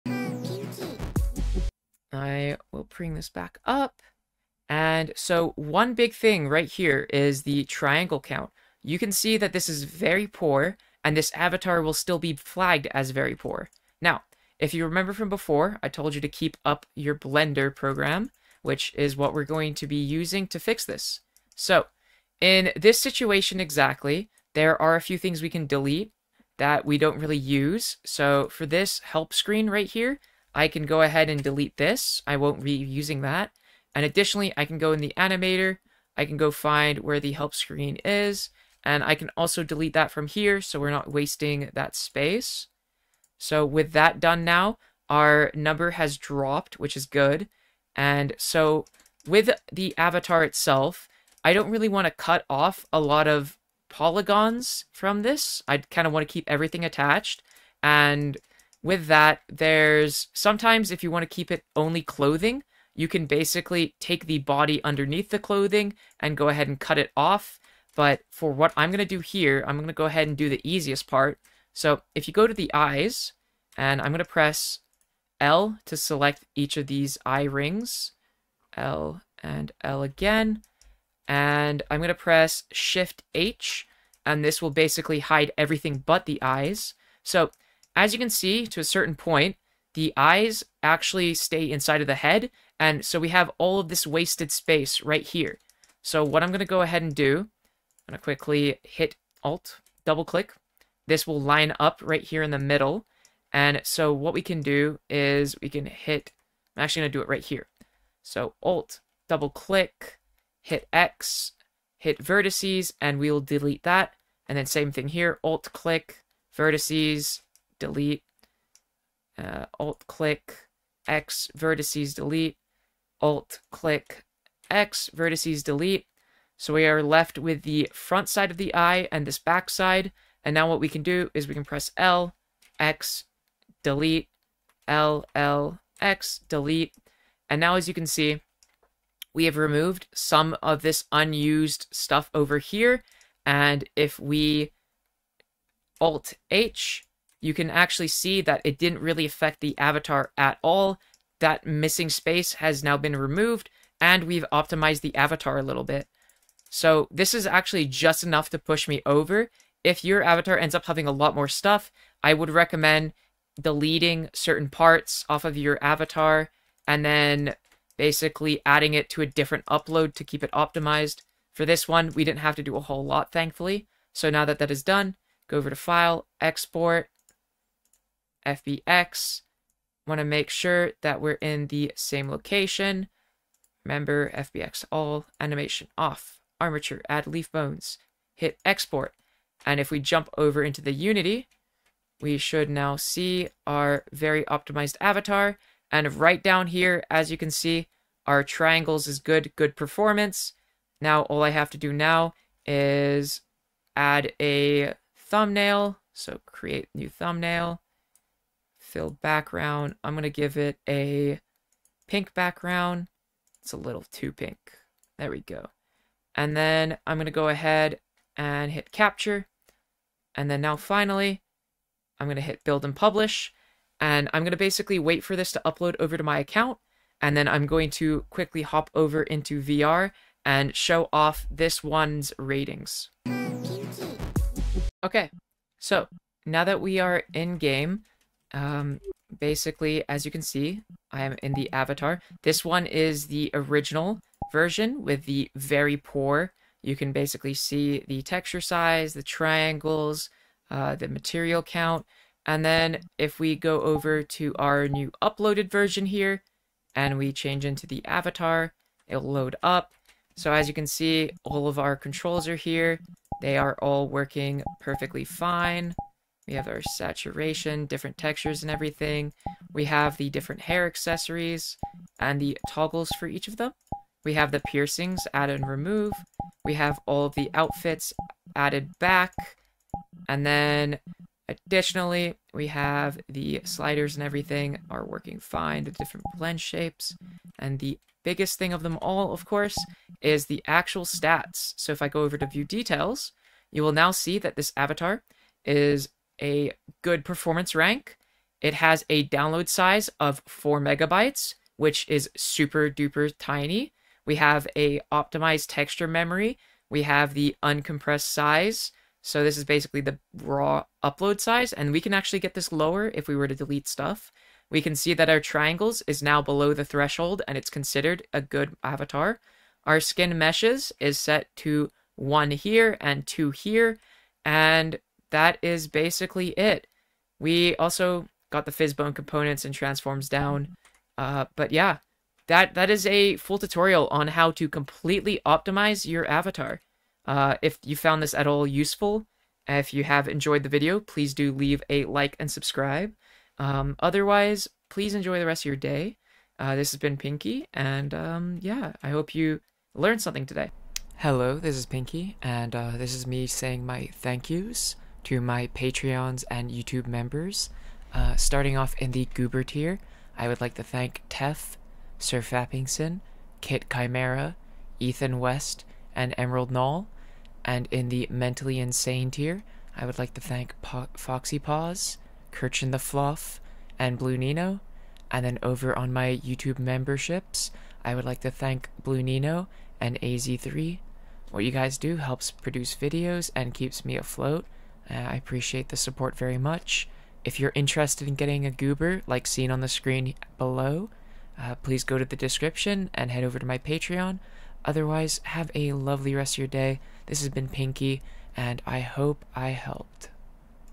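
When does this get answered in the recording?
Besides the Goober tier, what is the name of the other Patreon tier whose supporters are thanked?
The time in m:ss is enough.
6:08.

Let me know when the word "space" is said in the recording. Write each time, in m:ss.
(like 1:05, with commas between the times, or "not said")
0:41, 1:34, 2:32.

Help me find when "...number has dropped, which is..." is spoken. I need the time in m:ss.
0:45.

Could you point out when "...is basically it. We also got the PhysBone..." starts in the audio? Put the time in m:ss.
5:25.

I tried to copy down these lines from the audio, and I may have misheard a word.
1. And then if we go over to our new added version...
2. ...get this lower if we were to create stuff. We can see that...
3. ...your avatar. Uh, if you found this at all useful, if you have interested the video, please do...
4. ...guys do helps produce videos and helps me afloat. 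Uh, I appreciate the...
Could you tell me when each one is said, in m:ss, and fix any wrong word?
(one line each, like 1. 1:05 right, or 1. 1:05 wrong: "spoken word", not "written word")
1. 4:12 wrong: "uploaded", not "added"
2. 5:12 wrong: "delete", not "create"
3. 5:36 wrong: "enjoyed", not "interested"
4. 6:21 wrong: "keeps", not "helps".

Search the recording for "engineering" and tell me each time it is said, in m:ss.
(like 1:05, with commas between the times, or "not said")
not said.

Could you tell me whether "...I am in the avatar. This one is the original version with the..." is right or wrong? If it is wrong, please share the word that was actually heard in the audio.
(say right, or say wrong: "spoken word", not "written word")
right.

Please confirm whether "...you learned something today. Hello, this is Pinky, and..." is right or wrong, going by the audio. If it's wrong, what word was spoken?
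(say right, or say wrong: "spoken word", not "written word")
right.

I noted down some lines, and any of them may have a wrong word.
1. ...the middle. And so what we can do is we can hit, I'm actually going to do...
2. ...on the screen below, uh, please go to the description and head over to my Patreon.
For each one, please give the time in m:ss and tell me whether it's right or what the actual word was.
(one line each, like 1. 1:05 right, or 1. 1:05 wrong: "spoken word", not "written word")
1. 1:42 right
2. 6:29 right.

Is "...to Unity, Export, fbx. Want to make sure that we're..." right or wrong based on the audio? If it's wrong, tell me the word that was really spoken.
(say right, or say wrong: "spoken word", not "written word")
wrong: "File", not "Unity".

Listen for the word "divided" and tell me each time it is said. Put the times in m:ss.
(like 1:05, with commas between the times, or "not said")
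not said.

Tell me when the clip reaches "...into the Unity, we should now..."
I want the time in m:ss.
3:10.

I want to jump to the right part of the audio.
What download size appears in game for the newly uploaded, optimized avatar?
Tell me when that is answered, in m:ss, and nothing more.
5:00.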